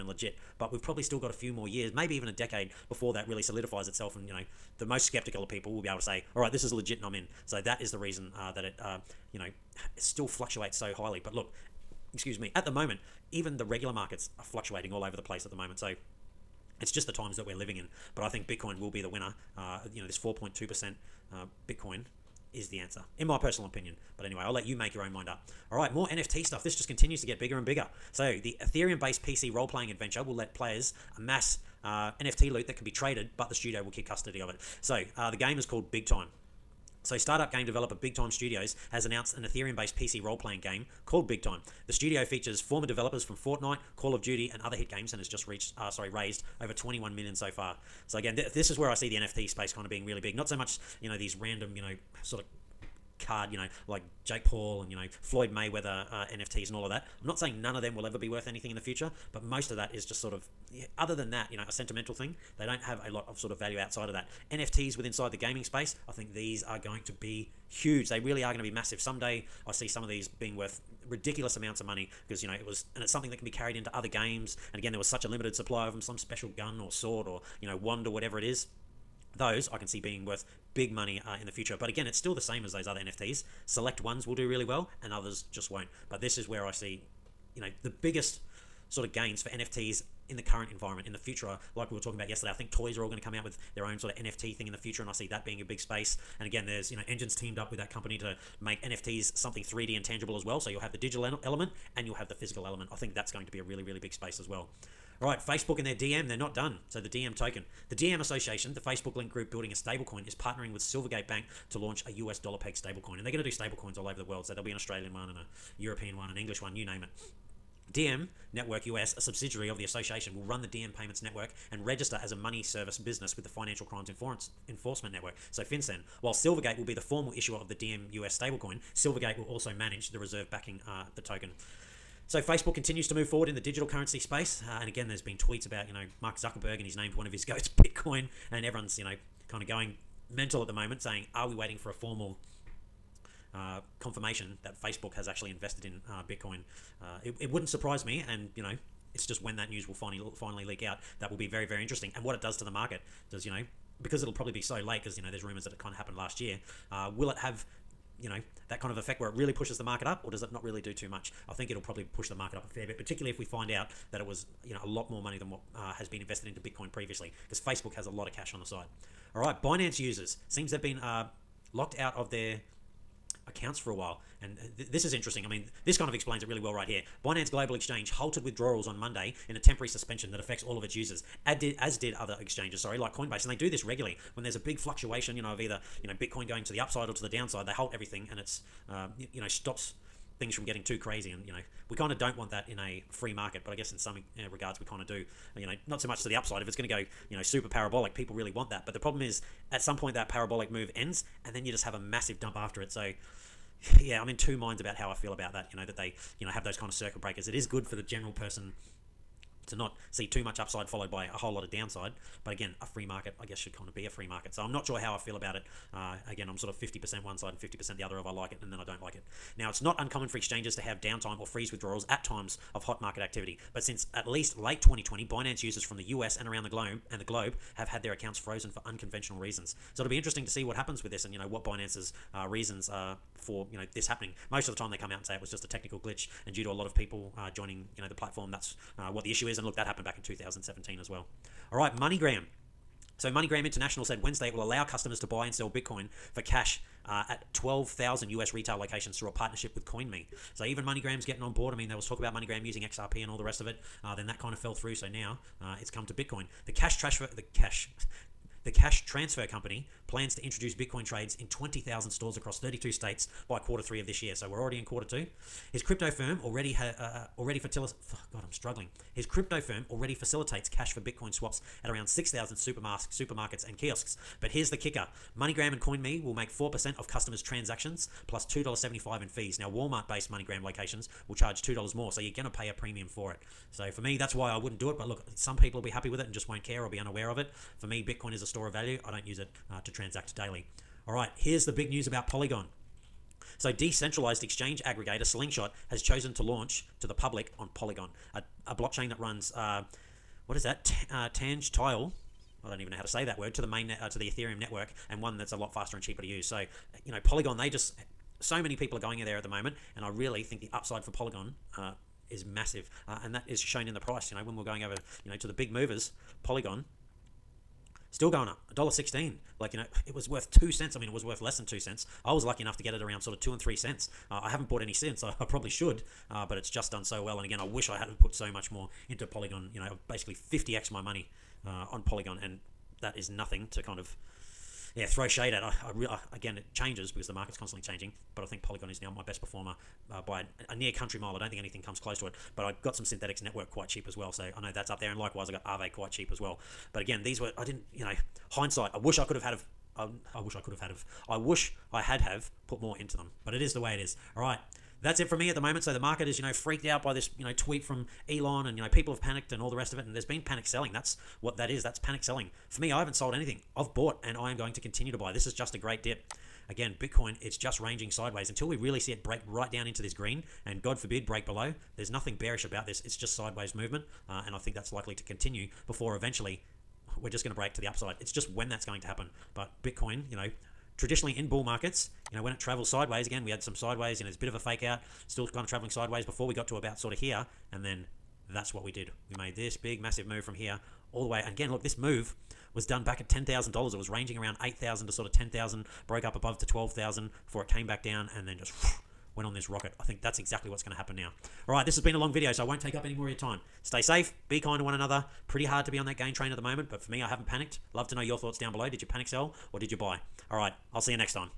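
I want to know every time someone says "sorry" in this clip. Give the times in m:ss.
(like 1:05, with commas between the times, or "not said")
0:45, 3:02.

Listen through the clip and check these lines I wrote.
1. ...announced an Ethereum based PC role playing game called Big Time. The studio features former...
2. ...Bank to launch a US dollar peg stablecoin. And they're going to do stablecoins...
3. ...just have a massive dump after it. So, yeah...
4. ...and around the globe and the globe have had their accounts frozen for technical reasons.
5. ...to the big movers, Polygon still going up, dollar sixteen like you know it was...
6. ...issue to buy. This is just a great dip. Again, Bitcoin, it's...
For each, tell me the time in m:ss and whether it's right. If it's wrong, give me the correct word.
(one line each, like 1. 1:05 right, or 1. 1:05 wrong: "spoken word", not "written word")
1. 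0:39 right
2. 1:51 right
3. 3:21 right
4. 3:46 wrong: "unconventional", not "technical"
5. 5:15 right
6. 6:04 wrong: "continue", not "issue".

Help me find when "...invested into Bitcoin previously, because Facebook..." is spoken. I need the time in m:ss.
2:46.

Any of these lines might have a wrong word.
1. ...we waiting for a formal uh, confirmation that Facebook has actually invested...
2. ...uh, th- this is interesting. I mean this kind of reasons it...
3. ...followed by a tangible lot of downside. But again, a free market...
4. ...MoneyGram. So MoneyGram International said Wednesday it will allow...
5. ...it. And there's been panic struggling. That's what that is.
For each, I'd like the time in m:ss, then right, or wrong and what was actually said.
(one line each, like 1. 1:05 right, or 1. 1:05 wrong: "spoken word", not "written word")
1. 2:21 right
2. 2:54 wrong: "explains", not "reasons"
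3. 3:30 wrong: "whole", not "tangible"
4. 4:01 right
5. 5:59 wrong: "selling", not "struggling".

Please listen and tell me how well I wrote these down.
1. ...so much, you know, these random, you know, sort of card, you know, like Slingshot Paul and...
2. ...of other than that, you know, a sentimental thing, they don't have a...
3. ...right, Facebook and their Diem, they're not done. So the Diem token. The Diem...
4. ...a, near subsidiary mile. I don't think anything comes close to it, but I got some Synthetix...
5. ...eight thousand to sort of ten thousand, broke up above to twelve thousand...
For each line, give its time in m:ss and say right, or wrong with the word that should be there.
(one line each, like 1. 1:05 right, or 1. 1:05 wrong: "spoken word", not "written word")
1. 0:50 wrong: "Jake", not "Slingshot"
2. 1:00 right
3. 1:45 right
4. 5:40 wrong: "country", not "subsidiary"
5. 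6:34 right.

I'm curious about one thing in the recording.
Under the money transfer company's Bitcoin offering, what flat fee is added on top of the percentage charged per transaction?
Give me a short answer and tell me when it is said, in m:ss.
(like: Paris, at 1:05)
$2.75, at 4:38.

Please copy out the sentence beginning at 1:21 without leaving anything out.
But again, it's still the same as those other NFTs.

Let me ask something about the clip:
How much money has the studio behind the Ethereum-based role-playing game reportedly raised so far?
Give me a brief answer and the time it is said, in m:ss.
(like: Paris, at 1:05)
21 million, at 0:46.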